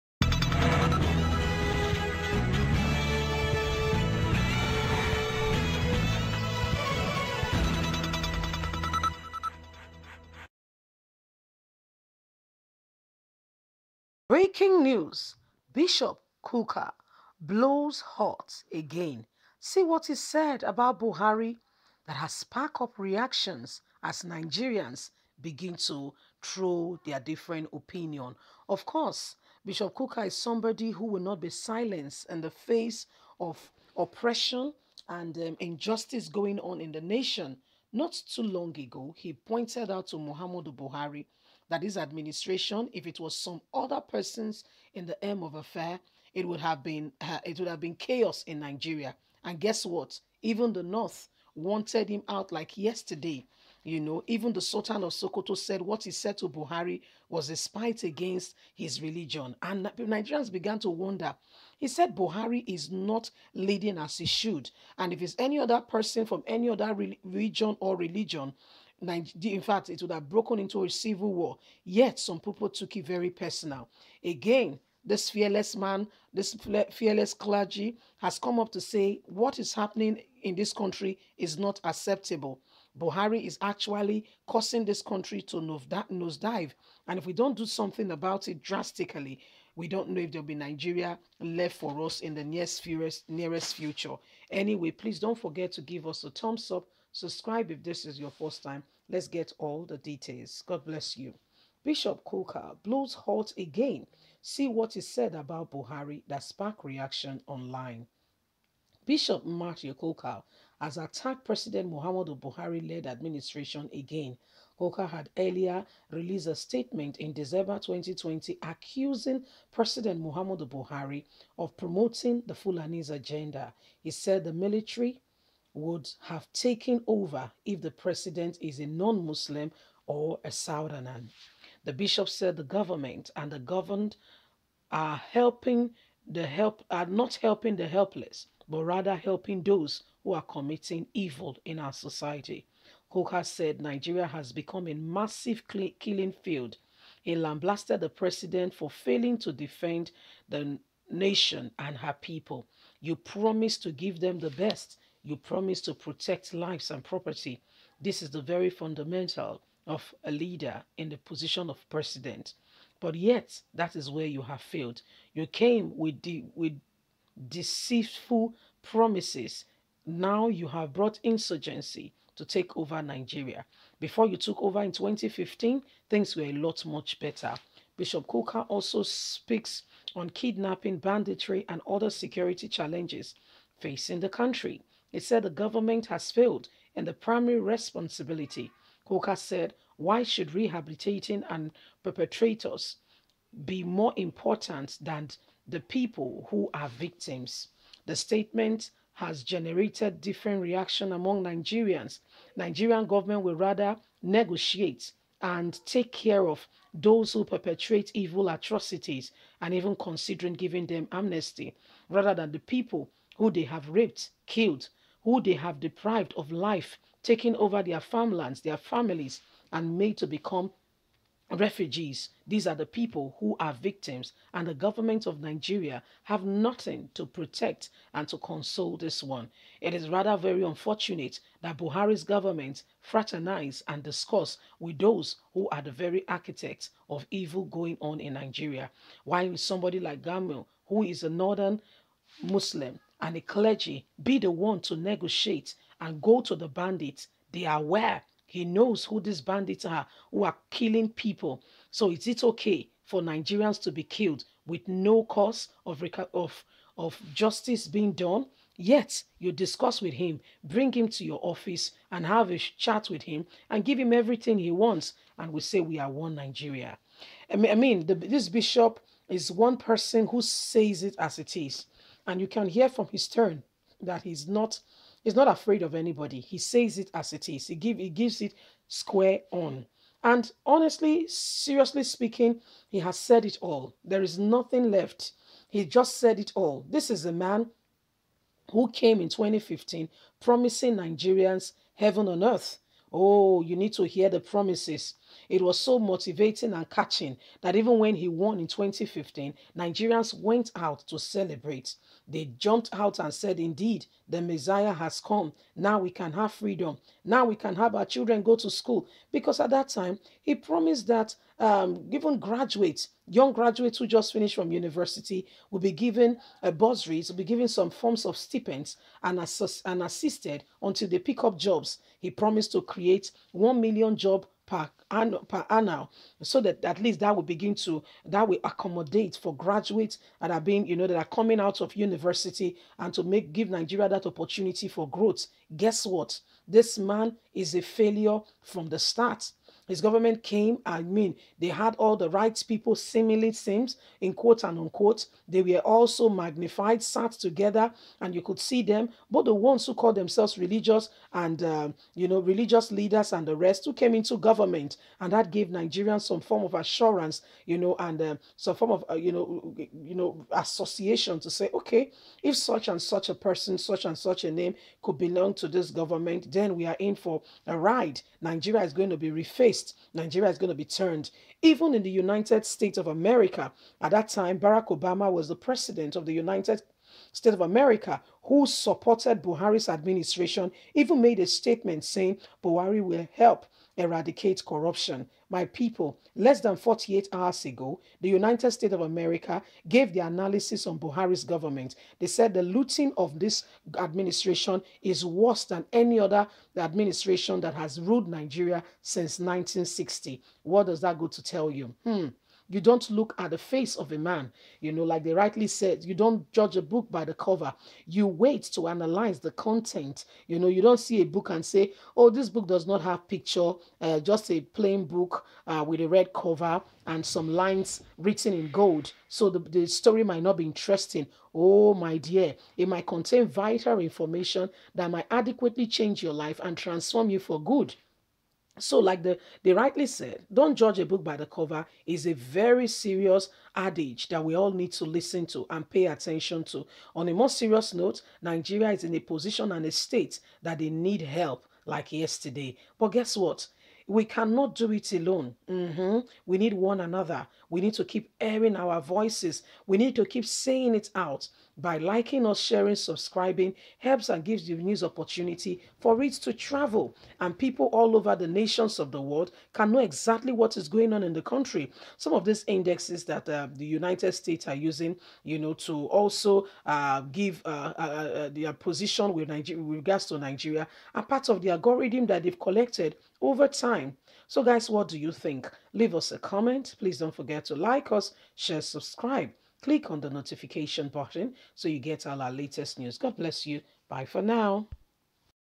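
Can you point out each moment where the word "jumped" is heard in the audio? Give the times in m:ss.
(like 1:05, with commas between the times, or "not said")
5:02.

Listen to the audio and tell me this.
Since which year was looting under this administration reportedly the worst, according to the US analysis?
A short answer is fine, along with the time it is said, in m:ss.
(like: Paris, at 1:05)
1960, at 6:39.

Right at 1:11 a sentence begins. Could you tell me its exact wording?
Yet some people took it very personal.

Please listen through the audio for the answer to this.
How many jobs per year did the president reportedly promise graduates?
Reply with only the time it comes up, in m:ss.
5:23.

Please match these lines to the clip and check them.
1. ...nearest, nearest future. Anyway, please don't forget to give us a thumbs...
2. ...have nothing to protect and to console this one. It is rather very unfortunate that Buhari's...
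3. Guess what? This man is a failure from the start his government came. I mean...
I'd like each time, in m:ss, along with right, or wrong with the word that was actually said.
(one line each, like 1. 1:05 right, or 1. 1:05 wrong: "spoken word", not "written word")
1. 1:32 right
2. 3:46 right
3. 5:35 right.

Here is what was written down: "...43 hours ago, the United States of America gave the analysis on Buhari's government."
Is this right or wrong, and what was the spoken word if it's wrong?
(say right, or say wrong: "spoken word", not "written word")
wrong: "48", not "43".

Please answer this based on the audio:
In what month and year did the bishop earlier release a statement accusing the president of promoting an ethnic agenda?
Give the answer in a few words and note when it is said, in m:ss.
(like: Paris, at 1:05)
December 2020, at 1:57.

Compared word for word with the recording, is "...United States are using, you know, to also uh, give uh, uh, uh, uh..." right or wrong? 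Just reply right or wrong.
right.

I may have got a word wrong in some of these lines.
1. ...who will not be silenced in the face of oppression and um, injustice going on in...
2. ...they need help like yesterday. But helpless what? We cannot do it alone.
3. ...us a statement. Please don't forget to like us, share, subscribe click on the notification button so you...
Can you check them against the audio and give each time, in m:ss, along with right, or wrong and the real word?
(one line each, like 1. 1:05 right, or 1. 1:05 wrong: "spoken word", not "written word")
1. 0:30 right
2. 7:20 wrong: "guess", not "helpless"
3. 7:56 wrong: "comment", not "statement".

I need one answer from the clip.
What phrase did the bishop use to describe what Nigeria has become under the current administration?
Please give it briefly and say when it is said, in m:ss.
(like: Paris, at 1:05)
massive killing field, at 2:24.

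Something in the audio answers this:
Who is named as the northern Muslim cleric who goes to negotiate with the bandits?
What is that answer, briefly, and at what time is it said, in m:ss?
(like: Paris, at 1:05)
Gamil, at 4:00.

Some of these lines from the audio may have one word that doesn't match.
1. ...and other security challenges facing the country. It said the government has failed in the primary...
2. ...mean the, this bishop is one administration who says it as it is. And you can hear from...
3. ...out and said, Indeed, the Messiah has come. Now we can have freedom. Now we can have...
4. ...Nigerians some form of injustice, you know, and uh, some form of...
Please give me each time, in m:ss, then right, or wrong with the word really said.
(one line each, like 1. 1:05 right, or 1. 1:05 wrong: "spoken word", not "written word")
1. 3:01 right
2. 4:27 wrong: "person", not "administration"
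3. 5:02 right
4. 5:55 wrong: "assurance", not "injustice".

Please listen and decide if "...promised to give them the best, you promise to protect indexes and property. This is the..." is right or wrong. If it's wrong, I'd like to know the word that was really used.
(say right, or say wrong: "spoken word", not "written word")
wrong: "lives", not "indexes".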